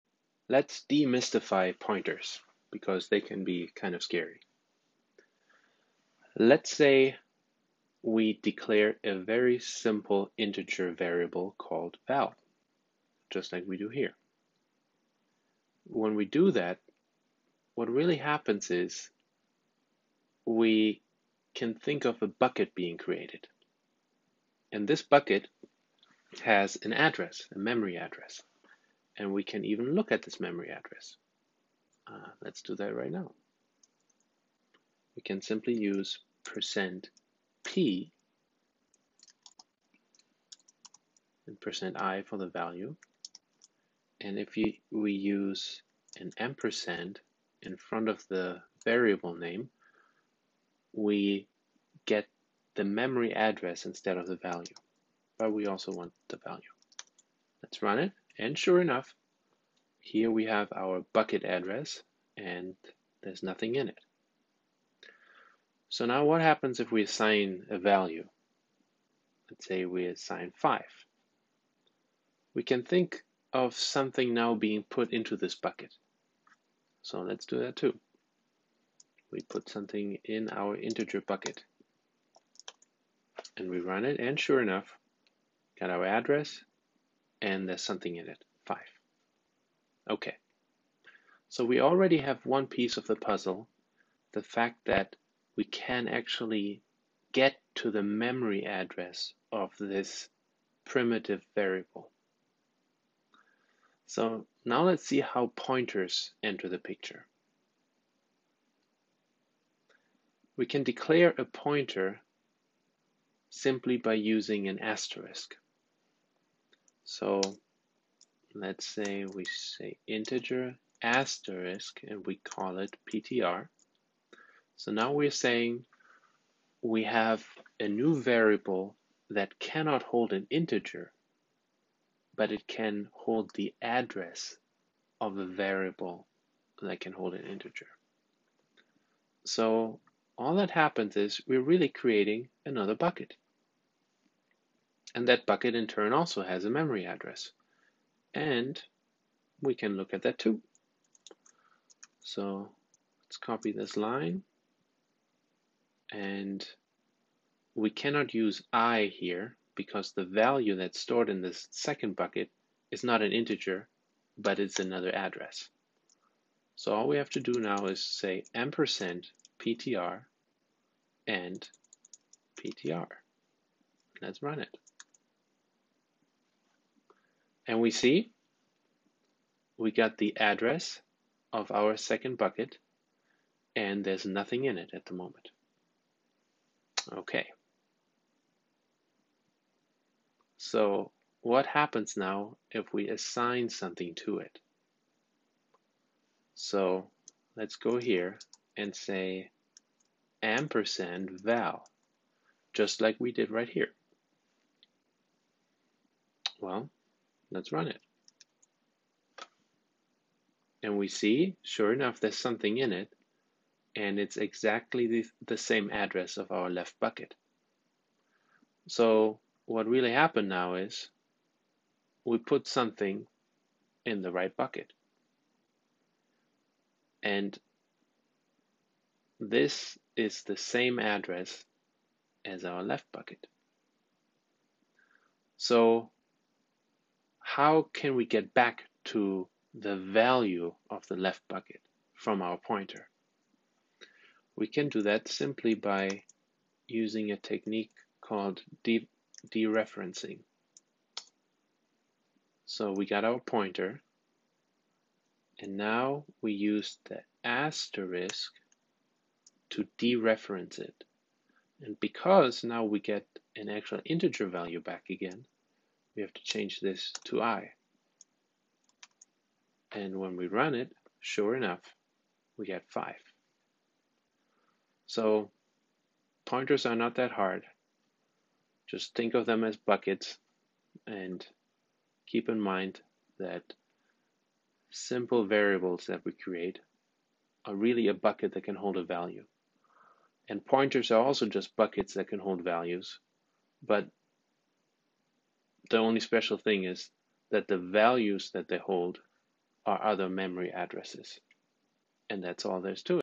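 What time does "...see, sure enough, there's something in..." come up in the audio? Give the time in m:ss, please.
3:31.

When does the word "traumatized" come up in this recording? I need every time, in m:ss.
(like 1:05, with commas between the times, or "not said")
not said.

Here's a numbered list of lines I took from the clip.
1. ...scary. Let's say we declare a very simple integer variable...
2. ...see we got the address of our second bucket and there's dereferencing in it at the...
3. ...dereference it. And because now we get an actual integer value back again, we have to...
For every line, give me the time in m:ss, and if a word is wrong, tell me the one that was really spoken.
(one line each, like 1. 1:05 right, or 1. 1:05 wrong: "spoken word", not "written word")
1. 0:04 right
2. 2:57 wrong: "nothing", not "dereferencing"
3. 4:19 right.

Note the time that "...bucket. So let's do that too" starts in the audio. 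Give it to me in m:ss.
1:15.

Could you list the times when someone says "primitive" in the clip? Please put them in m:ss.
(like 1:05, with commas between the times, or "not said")
1:40.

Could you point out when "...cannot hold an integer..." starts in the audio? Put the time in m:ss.
2:09.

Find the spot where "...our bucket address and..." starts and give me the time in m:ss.
1:00.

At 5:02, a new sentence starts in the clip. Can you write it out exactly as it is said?
And that's all there's to it.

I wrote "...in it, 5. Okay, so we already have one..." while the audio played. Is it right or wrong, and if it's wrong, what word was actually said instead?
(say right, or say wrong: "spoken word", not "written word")
right.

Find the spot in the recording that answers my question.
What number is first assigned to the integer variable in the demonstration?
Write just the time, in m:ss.
1:09.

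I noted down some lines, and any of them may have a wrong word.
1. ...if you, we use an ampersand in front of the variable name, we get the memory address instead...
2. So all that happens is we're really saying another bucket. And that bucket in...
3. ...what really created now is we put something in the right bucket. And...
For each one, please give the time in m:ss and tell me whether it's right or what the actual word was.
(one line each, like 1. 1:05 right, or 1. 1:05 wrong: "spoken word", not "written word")
1. 0:44 right
2. 2:19 wrong: "creating", not "saying"
3. 3:39 wrong: "happened", not "created".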